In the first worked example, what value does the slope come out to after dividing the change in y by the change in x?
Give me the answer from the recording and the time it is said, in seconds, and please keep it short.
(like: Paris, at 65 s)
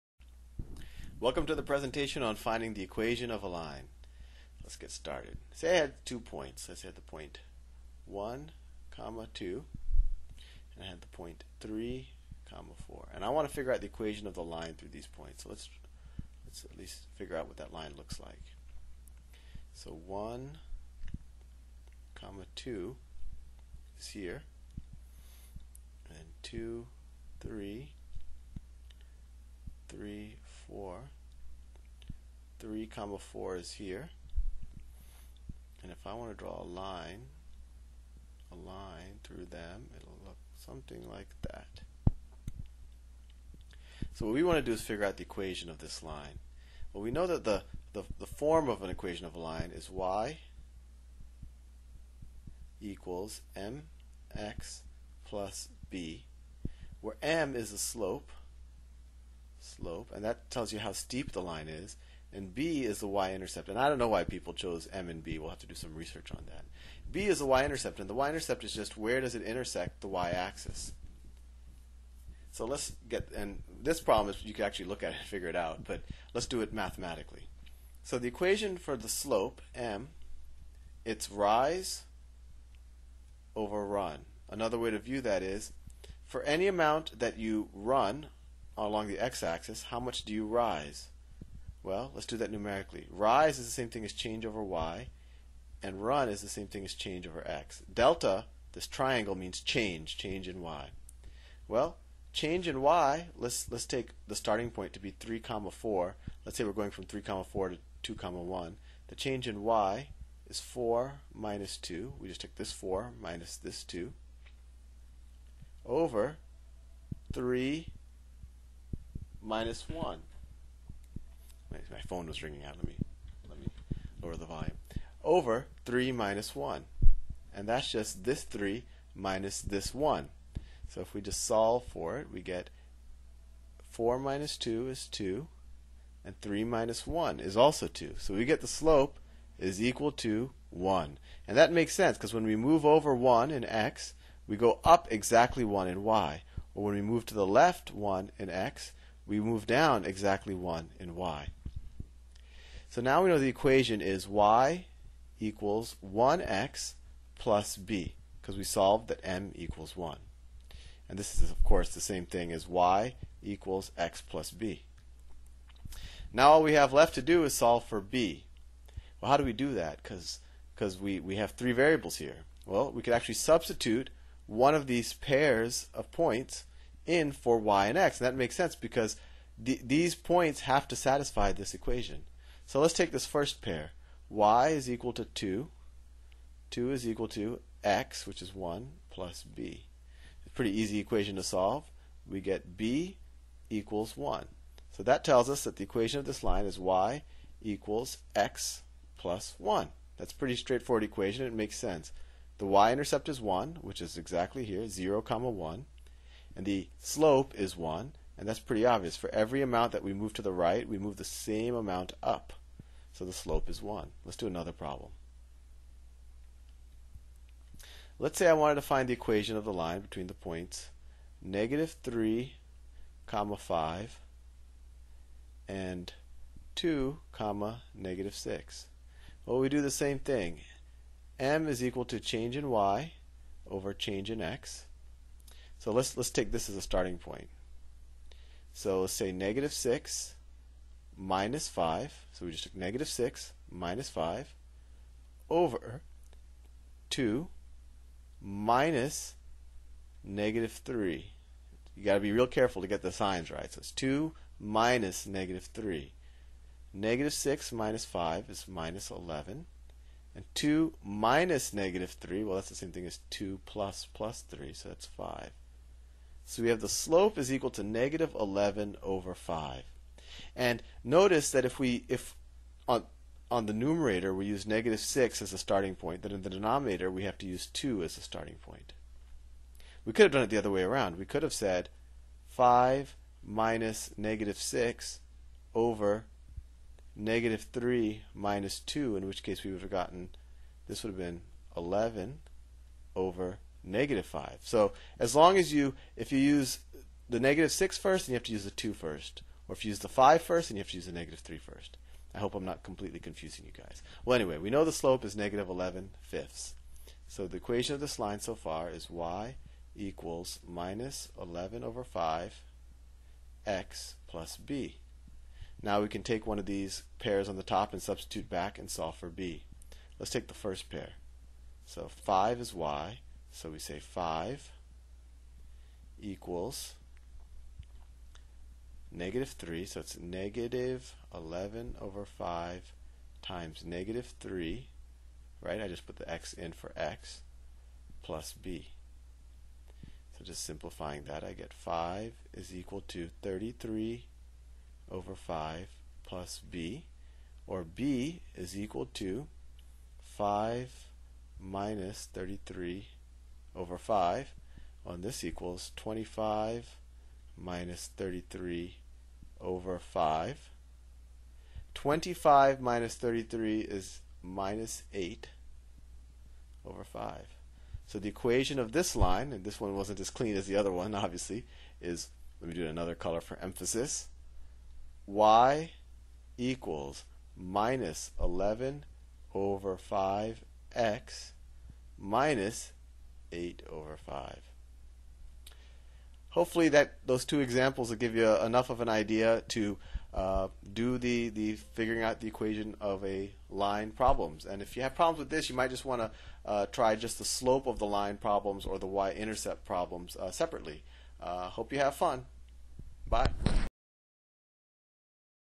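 1, at 138 s.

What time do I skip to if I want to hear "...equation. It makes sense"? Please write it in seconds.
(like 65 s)
201 s.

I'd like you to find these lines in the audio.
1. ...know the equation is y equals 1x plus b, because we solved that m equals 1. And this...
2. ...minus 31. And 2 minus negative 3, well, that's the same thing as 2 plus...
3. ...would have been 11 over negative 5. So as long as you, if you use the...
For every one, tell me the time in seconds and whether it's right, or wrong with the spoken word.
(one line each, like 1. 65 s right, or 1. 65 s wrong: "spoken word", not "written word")
1. 153 s right
2. 258 s wrong: "11", not "31"
3. 291 s right.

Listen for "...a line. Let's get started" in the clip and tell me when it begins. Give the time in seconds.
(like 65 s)
3 s.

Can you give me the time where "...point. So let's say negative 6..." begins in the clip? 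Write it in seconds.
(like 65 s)
237 s.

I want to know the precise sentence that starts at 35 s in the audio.
And if I want to draw a line, a line through them, it'll look something like that.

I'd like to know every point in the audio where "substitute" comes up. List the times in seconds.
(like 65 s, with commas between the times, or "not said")
173 s, 318 s.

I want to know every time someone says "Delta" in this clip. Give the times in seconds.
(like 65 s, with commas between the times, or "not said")
97 s.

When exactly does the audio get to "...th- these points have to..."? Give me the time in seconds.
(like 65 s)
179 s.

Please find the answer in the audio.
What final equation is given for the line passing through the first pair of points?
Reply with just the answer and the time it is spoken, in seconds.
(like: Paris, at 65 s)
y = x + 1, at 196 s.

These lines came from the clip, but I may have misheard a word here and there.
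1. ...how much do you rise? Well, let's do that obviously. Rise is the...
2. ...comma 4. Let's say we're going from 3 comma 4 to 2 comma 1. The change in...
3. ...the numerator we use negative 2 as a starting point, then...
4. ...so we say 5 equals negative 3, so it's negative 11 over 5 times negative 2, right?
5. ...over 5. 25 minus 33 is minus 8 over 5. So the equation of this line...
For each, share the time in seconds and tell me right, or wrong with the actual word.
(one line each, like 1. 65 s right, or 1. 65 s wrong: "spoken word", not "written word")
1. 89 s wrong: "numerically", not "obviously"
2. 105 s right
3. 273 s wrong: "6", not "2"
4. 323 s wrong: "3", not "2"
5. 359 s right.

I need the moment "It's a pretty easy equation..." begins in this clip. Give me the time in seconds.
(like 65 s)
190 s.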